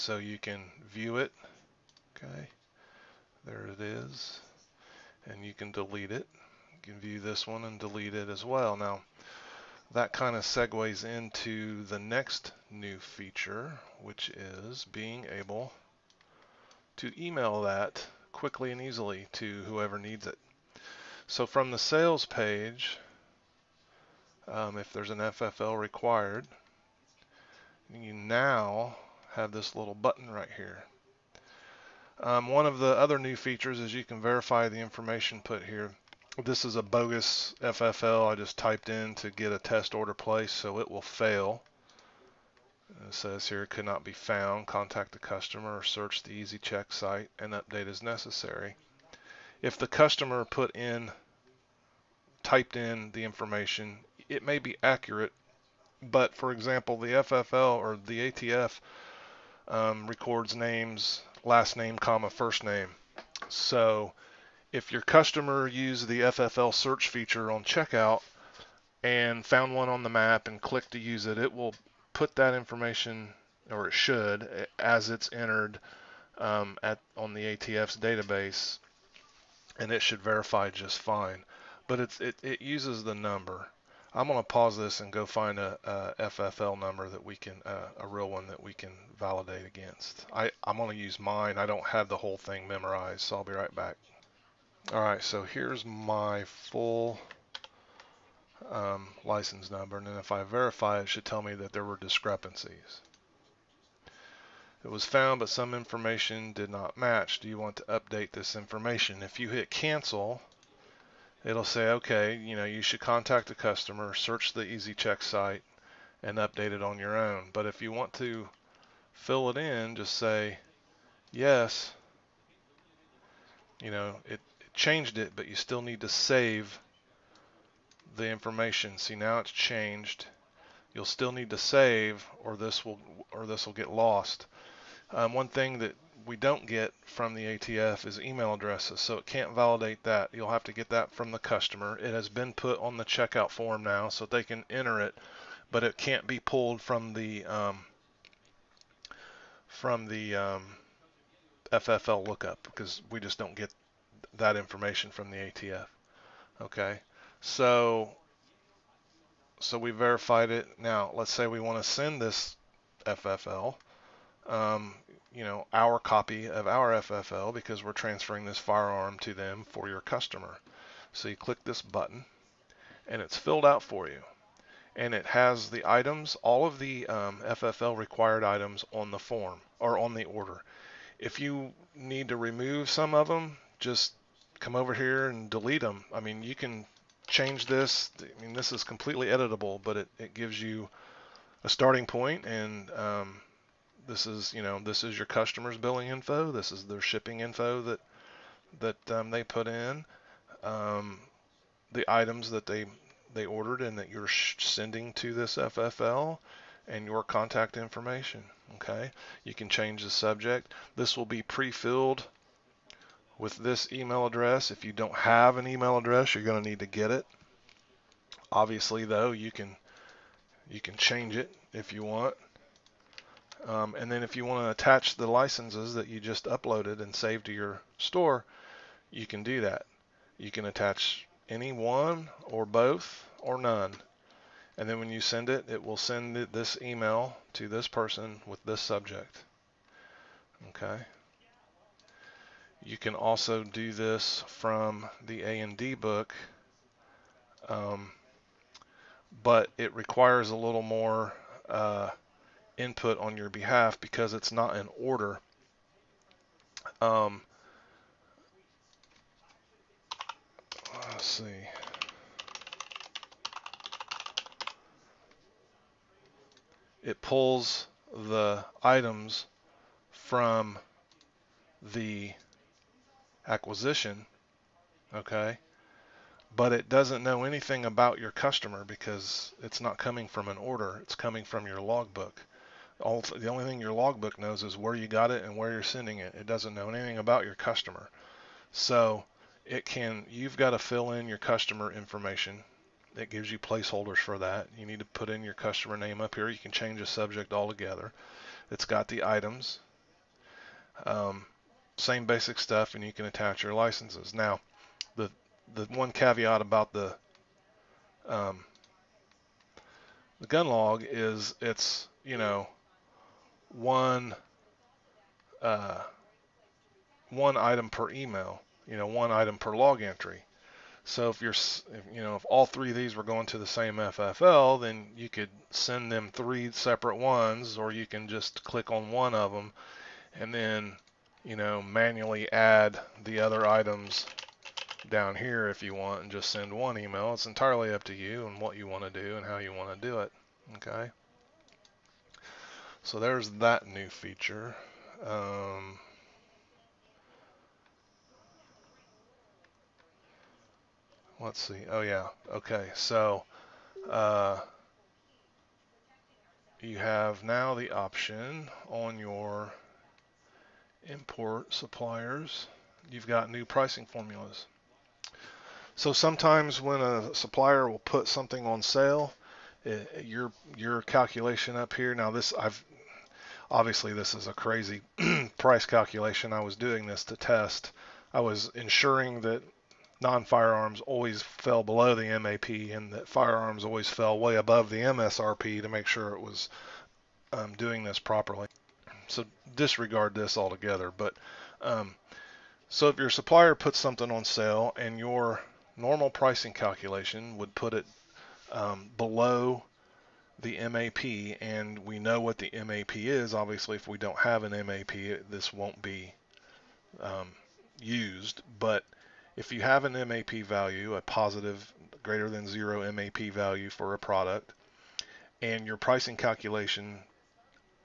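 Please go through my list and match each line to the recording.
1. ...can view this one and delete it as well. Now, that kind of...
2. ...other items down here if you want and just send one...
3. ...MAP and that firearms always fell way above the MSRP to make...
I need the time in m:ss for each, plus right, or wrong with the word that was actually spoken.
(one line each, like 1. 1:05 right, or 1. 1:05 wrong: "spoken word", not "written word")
1. 0:06 right
2. 5:33 right
3. 6:22 right.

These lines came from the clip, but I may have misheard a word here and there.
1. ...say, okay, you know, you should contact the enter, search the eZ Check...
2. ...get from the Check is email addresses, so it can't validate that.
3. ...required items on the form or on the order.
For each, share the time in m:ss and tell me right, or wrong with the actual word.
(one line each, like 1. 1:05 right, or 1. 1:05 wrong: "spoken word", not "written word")
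1. 1:51 wrong: "customer", not "enter"
2. 2:16 wrong: "ATF", not "Check"
3. 2:57 right.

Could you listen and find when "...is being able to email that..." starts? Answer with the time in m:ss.
0:14.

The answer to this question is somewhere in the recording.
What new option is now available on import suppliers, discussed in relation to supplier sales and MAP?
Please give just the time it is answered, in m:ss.
6:03.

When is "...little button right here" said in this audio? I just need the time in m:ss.
0:29.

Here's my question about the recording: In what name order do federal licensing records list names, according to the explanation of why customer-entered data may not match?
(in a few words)
last name, comma, first name.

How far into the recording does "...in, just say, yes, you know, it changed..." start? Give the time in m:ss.
1:59.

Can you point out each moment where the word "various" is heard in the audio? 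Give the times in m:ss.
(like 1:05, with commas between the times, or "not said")
not said.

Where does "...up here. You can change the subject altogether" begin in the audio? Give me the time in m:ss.
4:56.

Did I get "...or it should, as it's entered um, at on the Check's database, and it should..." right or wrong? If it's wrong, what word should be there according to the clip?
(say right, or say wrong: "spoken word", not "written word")
wrong: "ATF", not "Check".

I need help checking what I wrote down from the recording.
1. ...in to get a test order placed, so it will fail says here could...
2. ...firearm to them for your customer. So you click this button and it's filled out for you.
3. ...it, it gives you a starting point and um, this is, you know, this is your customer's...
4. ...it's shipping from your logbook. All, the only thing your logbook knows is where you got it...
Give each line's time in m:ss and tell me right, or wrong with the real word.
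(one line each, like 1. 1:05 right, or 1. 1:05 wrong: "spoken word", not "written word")
1. 0:38 right
2. 2:48 right
3. 3:09 right
4. 4:41 wrong: "coming", not "shipping".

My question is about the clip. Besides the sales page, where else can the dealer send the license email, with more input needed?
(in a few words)
A&D book.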